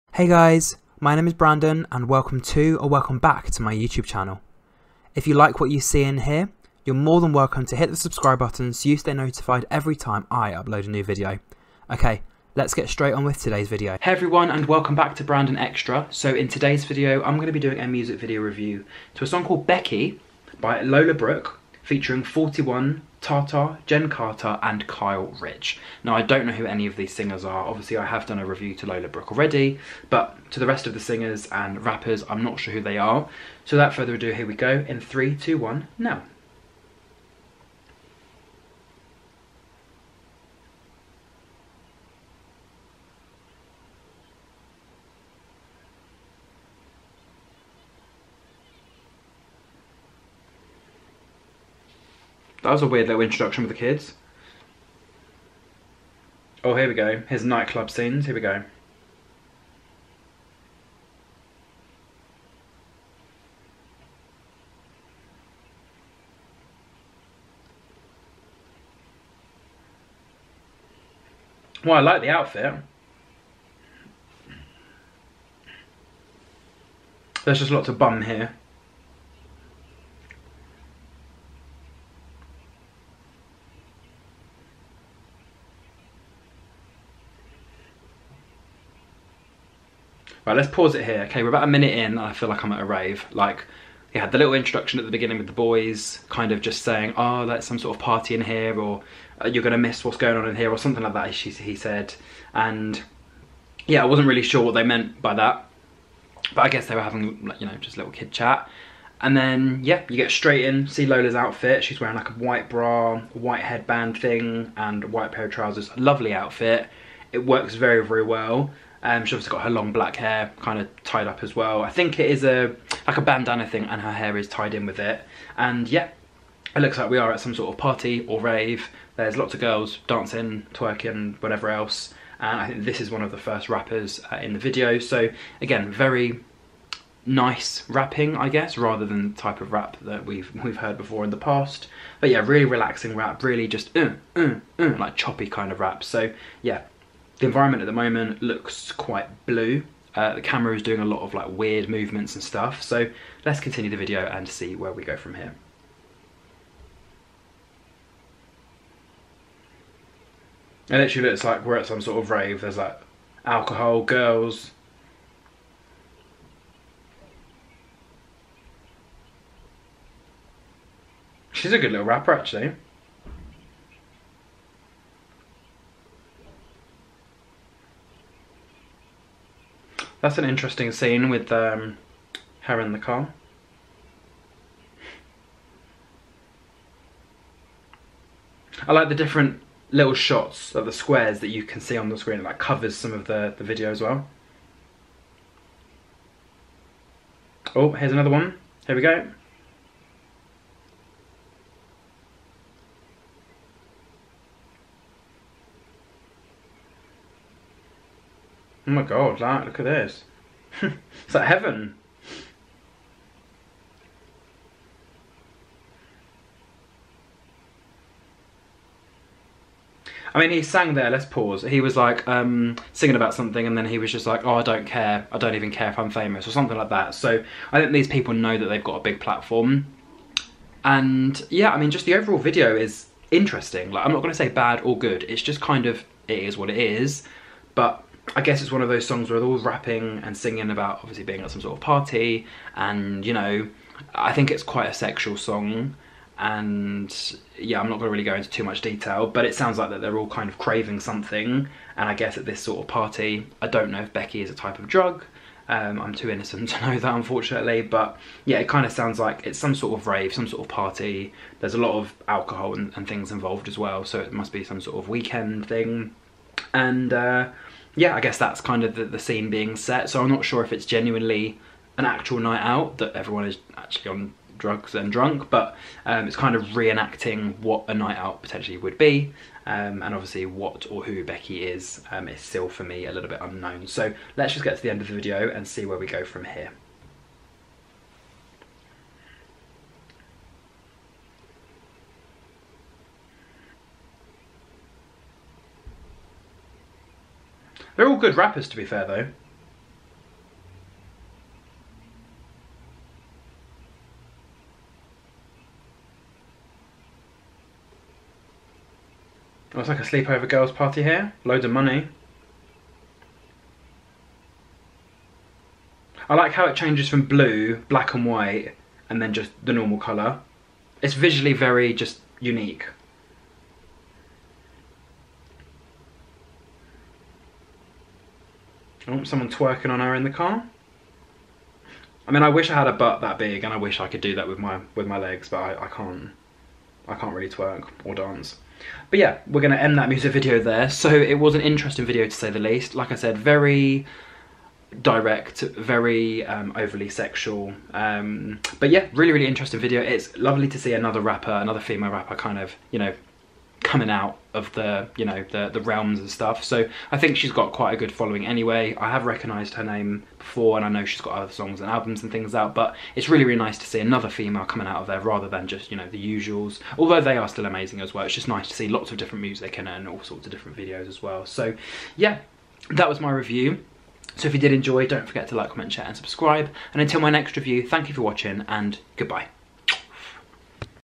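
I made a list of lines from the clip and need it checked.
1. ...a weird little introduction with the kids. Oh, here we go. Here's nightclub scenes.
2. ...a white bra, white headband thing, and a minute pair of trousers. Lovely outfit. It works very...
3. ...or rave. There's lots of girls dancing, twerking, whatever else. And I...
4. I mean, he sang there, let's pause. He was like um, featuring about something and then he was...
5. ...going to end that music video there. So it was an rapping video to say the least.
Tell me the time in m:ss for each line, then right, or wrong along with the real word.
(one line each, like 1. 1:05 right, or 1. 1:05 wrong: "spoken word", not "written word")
1. 0:52 right
2. 1:52 wrong: "white", not "minute"
3. 2:08 right
4. 3:40 wrong: "singing", not "featuring"
5. 5:39 wrong: "interesting", not "rapping".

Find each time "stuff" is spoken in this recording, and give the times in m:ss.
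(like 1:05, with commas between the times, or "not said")
2:32, 5:56.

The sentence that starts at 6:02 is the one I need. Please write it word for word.
But it's really really nice to see another female coming out of there rather than just you know the usuals.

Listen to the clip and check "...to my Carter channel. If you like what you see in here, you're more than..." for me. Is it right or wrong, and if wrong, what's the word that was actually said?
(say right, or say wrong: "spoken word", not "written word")
wrong: "YouTube", not "Carter".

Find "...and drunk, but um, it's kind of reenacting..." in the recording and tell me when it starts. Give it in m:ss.
4:34.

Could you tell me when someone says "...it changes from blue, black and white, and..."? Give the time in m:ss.
5:16.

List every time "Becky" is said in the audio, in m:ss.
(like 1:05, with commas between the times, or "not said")
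0:19, 4:14, 4:41.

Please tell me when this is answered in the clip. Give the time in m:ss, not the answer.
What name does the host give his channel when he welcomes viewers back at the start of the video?
0:15.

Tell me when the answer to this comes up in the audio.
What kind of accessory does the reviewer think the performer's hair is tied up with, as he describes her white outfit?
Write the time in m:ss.
2:03.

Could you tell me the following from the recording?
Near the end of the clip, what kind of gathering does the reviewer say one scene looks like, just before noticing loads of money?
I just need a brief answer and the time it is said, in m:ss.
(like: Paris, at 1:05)
sleepover girls party, at 5:10.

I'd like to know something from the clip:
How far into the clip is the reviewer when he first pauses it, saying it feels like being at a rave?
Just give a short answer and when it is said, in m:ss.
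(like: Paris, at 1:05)
a minute, at 1:31.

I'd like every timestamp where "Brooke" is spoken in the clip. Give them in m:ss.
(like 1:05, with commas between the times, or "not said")
0:21, 0:29.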